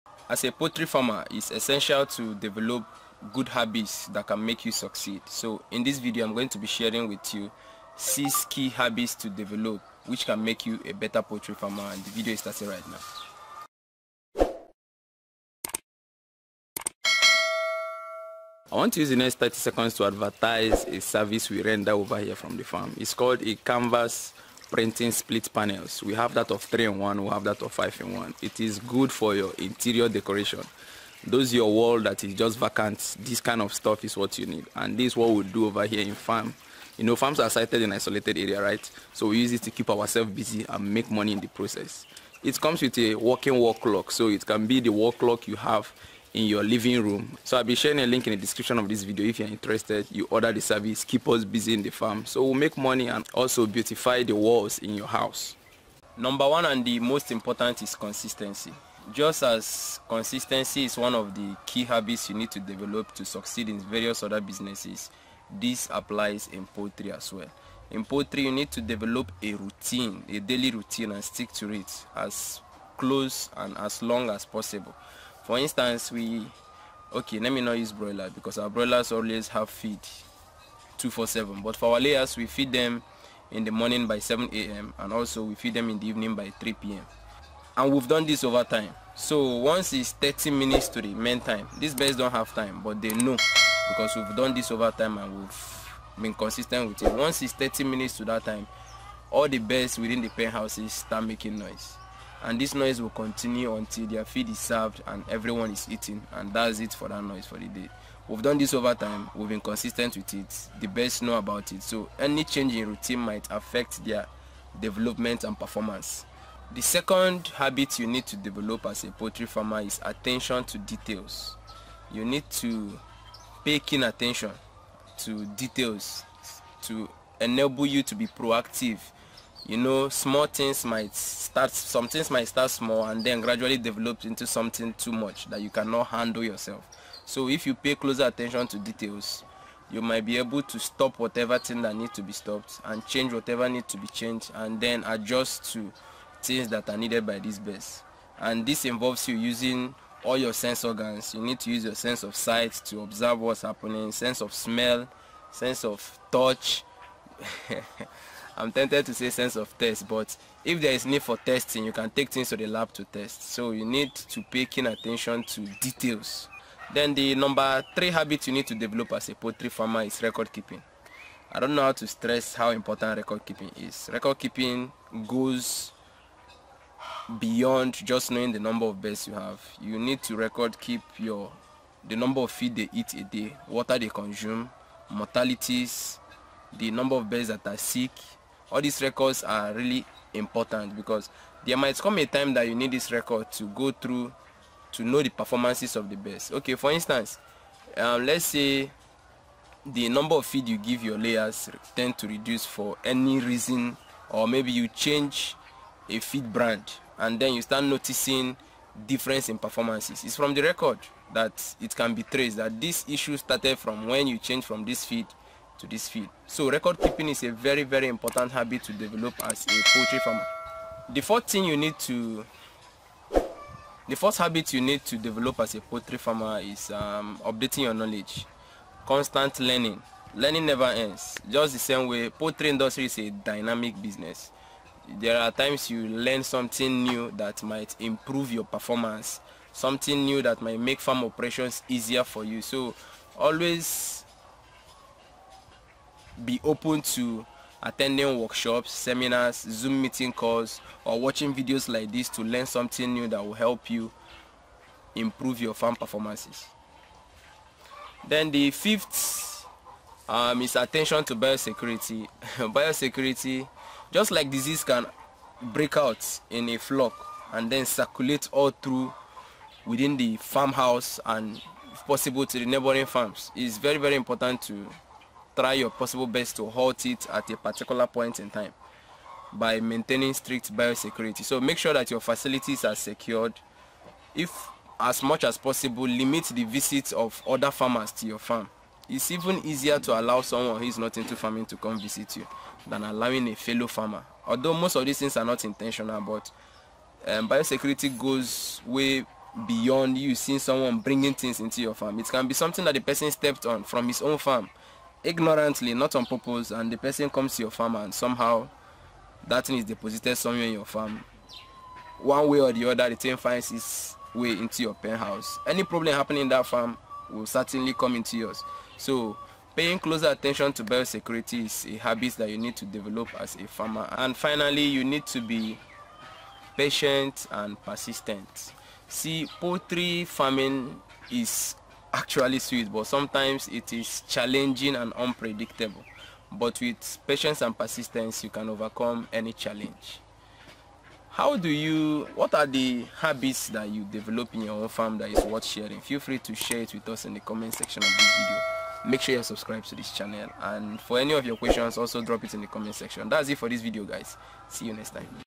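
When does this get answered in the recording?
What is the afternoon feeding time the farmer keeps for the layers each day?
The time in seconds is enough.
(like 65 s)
86 s.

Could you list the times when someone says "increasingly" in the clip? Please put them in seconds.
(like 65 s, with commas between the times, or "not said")
not said.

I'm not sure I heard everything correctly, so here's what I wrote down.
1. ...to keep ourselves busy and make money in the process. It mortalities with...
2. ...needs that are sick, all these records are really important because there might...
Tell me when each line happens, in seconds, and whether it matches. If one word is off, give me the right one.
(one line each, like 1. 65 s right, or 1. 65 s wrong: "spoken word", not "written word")
1. 39 s wrong: "comes", not "mortalities"
2. 187 s wrong: "birds", not "needs".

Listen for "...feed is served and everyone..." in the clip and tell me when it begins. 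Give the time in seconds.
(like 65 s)
104 s.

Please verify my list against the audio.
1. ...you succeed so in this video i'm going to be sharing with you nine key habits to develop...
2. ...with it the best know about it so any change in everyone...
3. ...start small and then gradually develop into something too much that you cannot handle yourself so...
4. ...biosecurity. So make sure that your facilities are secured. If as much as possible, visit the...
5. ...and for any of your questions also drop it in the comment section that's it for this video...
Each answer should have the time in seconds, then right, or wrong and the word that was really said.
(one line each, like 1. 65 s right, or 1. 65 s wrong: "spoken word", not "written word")
1. 4 s wrong: "six", not "nine"
2. 110 s wrong: "routine", not "everyone"
3. 132 s right
4. 280 s wrong: "limit", not "visit"
5. 350 s right.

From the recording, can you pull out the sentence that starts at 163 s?
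So you need to pay keen attention to details.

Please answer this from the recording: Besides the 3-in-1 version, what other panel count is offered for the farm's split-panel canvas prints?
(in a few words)
5 in 1.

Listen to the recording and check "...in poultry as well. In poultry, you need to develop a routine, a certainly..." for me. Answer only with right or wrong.
wrong.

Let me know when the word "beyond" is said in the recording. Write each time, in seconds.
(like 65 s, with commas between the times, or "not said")
177 s, 299 s.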